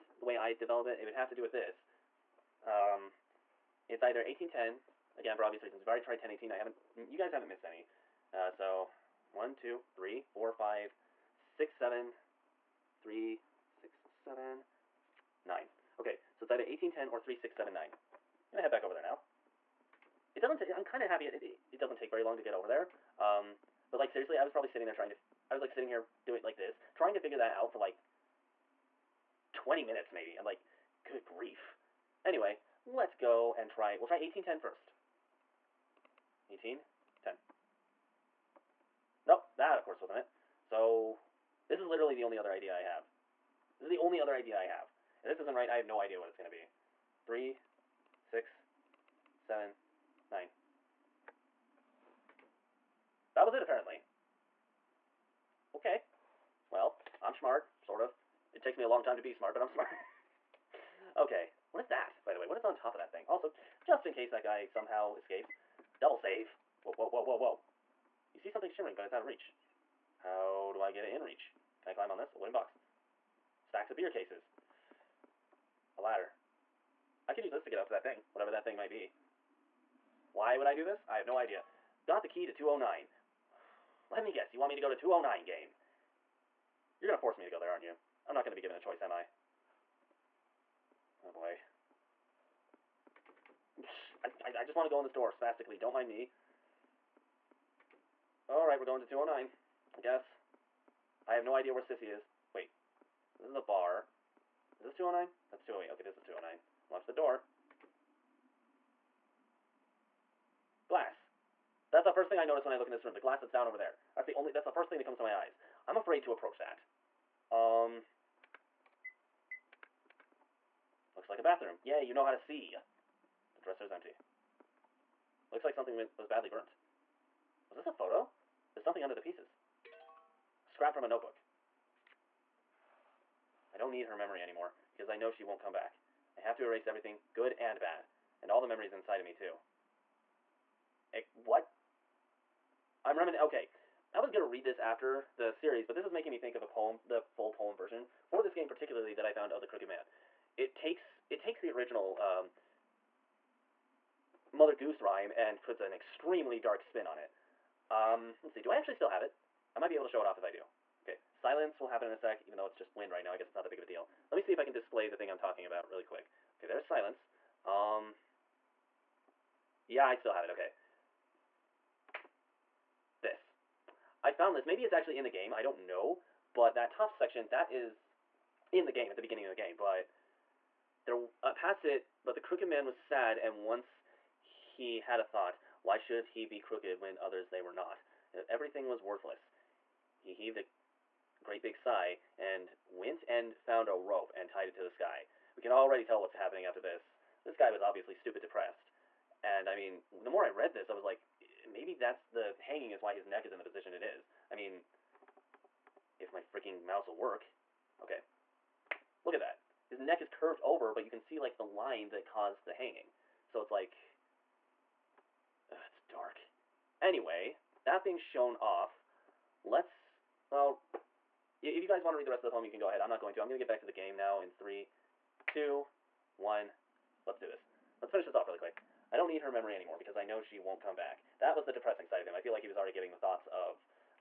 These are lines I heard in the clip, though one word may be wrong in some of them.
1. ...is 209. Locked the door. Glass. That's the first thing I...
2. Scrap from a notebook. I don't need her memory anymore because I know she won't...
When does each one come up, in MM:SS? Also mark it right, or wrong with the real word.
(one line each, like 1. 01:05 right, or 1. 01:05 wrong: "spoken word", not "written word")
1. 01:46 right
2. 02:10 right.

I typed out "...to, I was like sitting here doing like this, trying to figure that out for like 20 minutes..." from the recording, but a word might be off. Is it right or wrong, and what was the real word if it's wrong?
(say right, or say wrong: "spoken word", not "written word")
right.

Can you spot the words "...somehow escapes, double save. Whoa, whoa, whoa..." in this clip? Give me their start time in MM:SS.
01:04.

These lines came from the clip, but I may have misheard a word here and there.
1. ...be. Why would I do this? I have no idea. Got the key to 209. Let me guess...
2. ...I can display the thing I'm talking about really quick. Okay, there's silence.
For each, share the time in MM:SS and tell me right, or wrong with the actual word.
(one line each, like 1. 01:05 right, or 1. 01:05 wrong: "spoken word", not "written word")
1. 01:18 right
2. 02:44 right.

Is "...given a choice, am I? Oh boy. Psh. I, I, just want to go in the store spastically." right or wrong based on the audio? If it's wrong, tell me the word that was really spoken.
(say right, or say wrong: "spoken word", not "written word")
right.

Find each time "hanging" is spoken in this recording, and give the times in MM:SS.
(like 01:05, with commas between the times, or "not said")
03:22, 03:32.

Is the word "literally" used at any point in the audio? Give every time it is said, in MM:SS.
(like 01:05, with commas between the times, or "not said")
00:41.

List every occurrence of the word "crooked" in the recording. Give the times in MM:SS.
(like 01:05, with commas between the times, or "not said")
02:29, 03:02, 03:06.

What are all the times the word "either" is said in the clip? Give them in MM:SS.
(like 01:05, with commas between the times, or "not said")
00:04, 00:16.